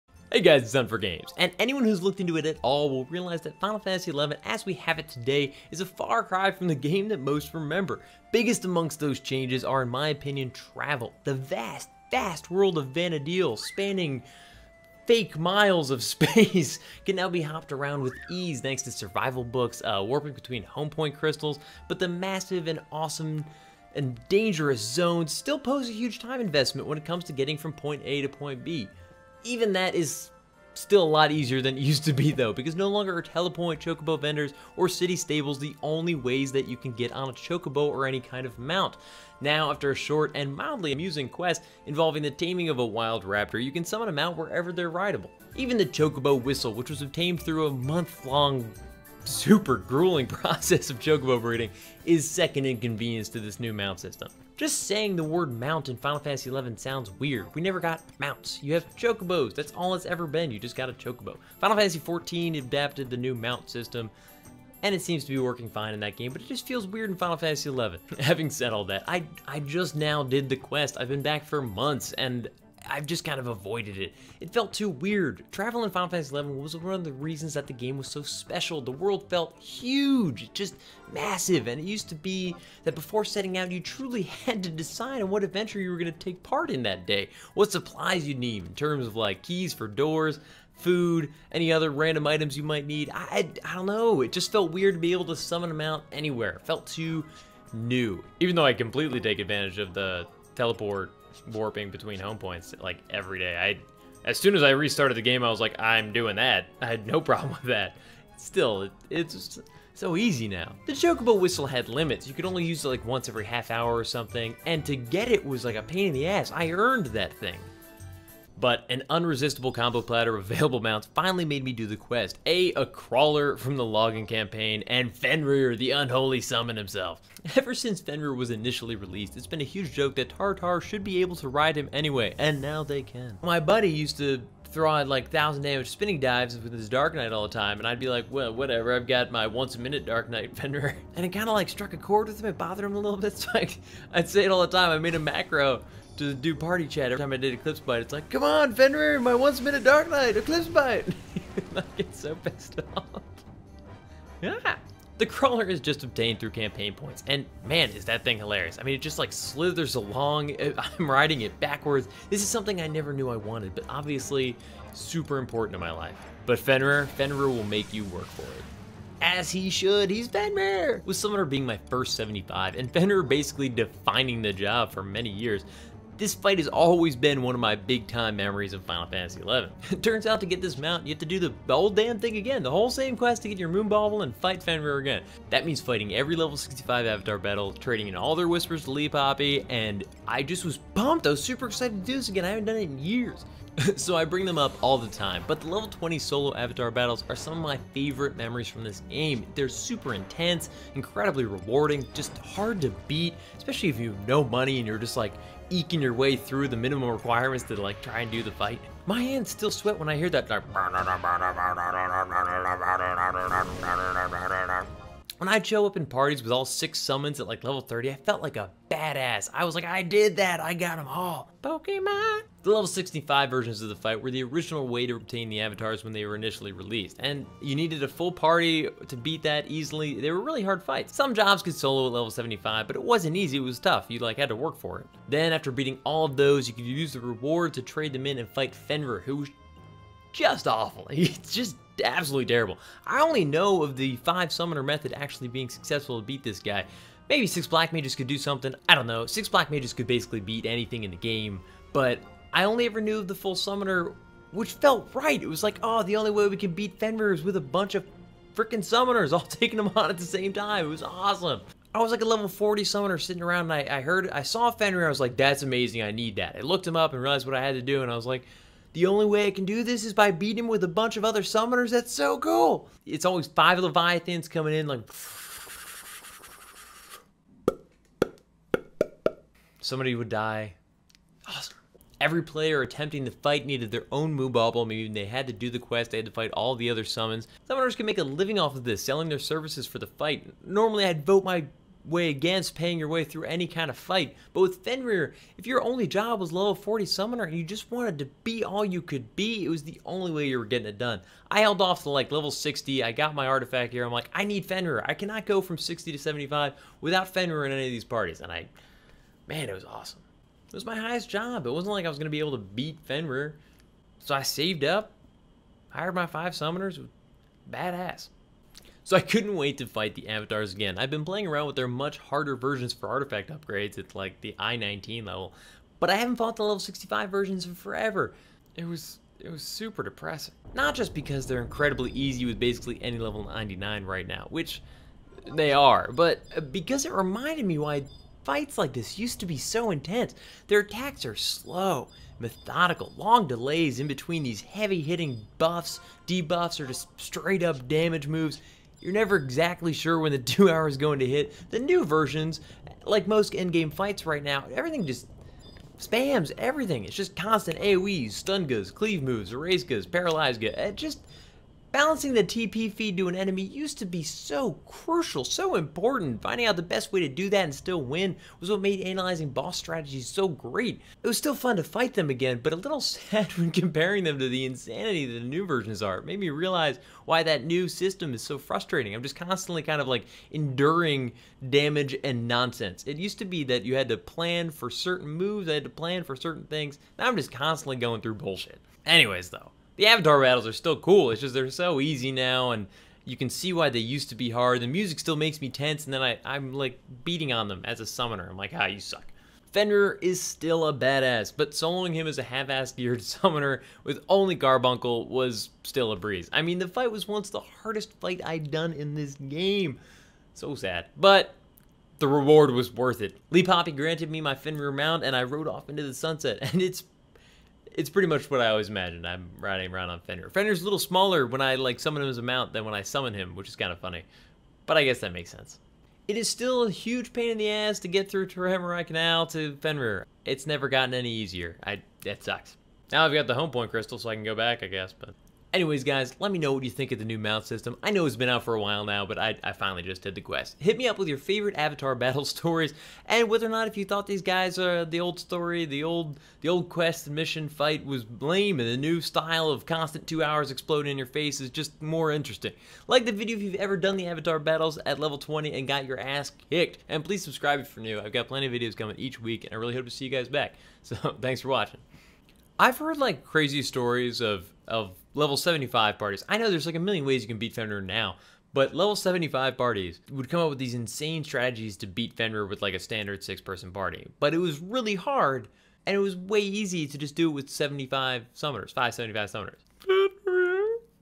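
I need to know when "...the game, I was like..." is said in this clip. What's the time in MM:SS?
01:45.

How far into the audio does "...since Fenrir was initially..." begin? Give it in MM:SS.
02:07.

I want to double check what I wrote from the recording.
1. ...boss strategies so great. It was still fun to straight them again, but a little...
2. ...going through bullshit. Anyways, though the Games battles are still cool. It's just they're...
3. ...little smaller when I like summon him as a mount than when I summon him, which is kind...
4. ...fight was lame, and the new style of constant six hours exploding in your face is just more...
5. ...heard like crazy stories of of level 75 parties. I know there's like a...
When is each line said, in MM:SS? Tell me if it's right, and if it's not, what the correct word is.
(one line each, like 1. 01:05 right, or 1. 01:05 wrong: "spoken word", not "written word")
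1. 06:09 wrong: "fight", not "straight"
2. 06:27 wrong: "Avatar", not "Games"
3. 07:00 right
4. 07:27 wrong: "two", not "six"
5. 07:42 right.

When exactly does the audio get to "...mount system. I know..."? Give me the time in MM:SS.
07:17.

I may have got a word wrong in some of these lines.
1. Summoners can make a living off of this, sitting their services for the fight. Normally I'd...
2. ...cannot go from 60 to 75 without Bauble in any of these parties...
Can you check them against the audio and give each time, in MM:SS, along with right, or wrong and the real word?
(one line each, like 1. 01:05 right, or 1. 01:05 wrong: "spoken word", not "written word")
1. 04:47 wrong: "selling", not "sitting"
2. 05:05 wrong: "Fenrir", not "Bauble".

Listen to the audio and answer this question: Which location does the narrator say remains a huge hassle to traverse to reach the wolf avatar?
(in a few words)
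Toraimarai Canal.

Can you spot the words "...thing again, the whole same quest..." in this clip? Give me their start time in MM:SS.
03:02.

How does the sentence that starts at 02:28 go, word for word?
It's like, come on, Fenrir, my once minute Dark Knight, Eclipse Bite.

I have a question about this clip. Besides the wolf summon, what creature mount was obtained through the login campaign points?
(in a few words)
A crawler.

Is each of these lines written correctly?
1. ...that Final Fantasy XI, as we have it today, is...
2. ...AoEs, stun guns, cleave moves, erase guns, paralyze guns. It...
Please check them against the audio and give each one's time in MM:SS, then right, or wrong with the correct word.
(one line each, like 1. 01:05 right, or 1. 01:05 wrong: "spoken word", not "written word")
1. 00:03 right
2. 05:57 right.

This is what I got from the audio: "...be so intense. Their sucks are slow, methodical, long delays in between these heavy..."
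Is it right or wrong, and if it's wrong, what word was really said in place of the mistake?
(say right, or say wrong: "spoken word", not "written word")
wrong: "attacks", not "sucks".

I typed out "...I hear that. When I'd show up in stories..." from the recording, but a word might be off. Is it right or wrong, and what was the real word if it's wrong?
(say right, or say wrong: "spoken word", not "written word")
wrong: "parties", not "stories".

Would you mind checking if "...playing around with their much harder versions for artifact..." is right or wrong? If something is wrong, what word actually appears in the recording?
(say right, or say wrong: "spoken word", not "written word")
right.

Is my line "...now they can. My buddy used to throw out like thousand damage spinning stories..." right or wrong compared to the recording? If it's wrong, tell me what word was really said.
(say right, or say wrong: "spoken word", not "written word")
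wrong: "dives", not "stories".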